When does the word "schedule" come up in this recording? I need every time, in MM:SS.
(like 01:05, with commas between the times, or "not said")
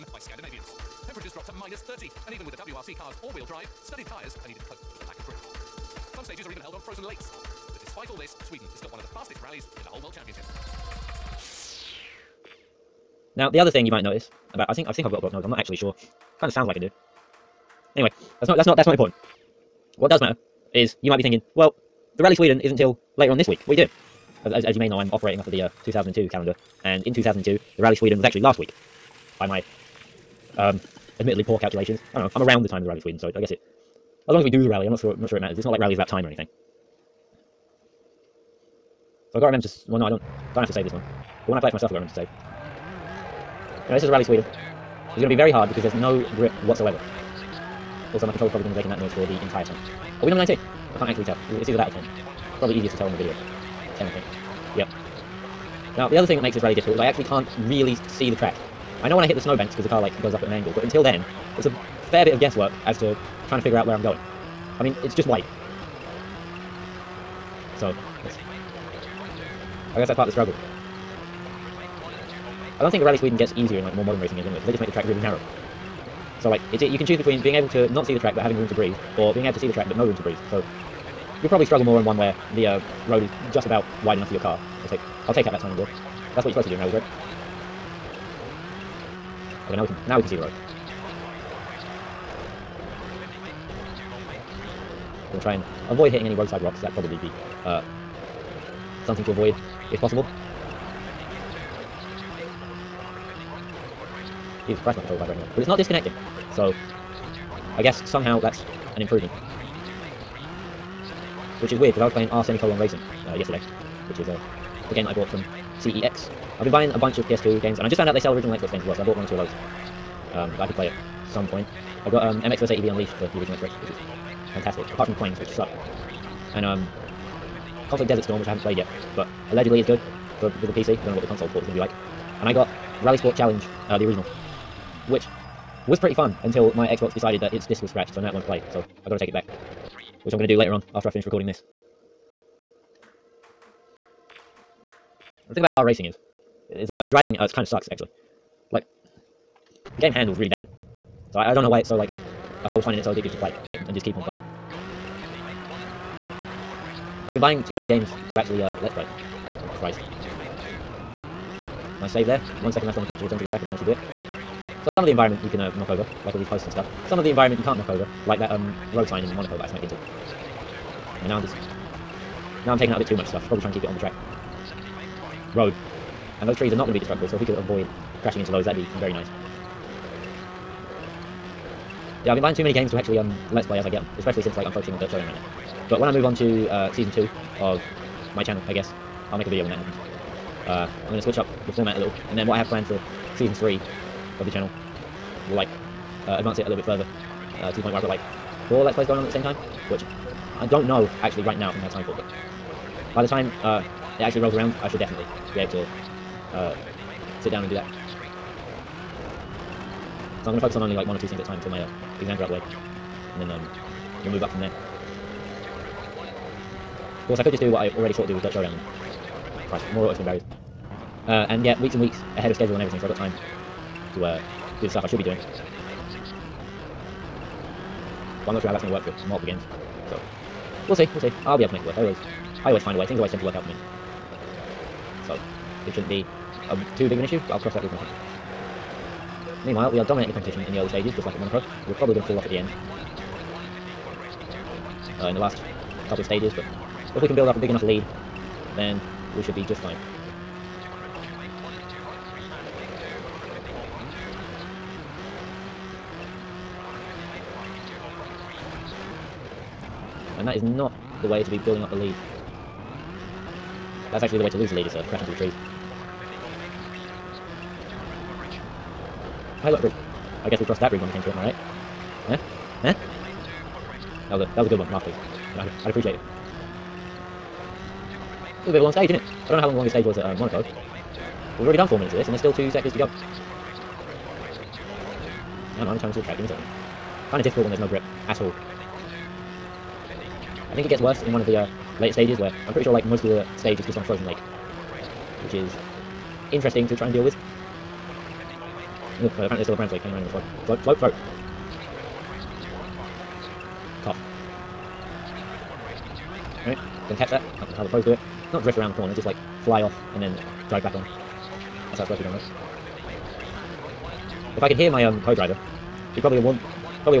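03:42.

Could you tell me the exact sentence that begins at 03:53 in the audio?
Things always tend to work out for me.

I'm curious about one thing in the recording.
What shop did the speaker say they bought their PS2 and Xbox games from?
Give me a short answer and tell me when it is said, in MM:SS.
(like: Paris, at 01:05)
CEX, at 01:55.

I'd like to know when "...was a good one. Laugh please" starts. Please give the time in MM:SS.
04:34.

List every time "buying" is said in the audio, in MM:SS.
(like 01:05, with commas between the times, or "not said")
01:56, 02:37, 03:02.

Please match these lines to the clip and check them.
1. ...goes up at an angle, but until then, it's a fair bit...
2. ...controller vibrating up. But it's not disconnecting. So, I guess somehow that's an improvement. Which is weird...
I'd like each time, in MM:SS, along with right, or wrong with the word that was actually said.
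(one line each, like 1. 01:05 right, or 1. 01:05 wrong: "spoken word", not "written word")
1. 01:00 right
2. 01:45 right.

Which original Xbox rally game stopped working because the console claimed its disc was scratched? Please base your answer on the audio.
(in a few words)
RalliSport Challenge.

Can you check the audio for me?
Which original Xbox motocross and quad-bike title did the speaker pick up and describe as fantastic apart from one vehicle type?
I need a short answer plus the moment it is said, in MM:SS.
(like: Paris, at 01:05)
MX vs ATV Unleashed, at 02:02.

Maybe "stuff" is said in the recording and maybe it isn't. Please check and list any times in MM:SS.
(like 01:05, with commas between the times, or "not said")
02:46, 02:53, 03:44.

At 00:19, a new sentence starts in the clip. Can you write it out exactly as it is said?
What does matter is you might be thinking, well, the Rally Sweden isn't till later on this week.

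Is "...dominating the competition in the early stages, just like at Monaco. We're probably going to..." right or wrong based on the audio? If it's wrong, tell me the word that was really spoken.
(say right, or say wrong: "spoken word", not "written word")
right.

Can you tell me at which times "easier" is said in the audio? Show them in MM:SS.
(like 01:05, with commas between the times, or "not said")
00:52, 01:13.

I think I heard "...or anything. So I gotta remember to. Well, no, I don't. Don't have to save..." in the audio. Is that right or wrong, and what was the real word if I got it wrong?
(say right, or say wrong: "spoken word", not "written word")
right.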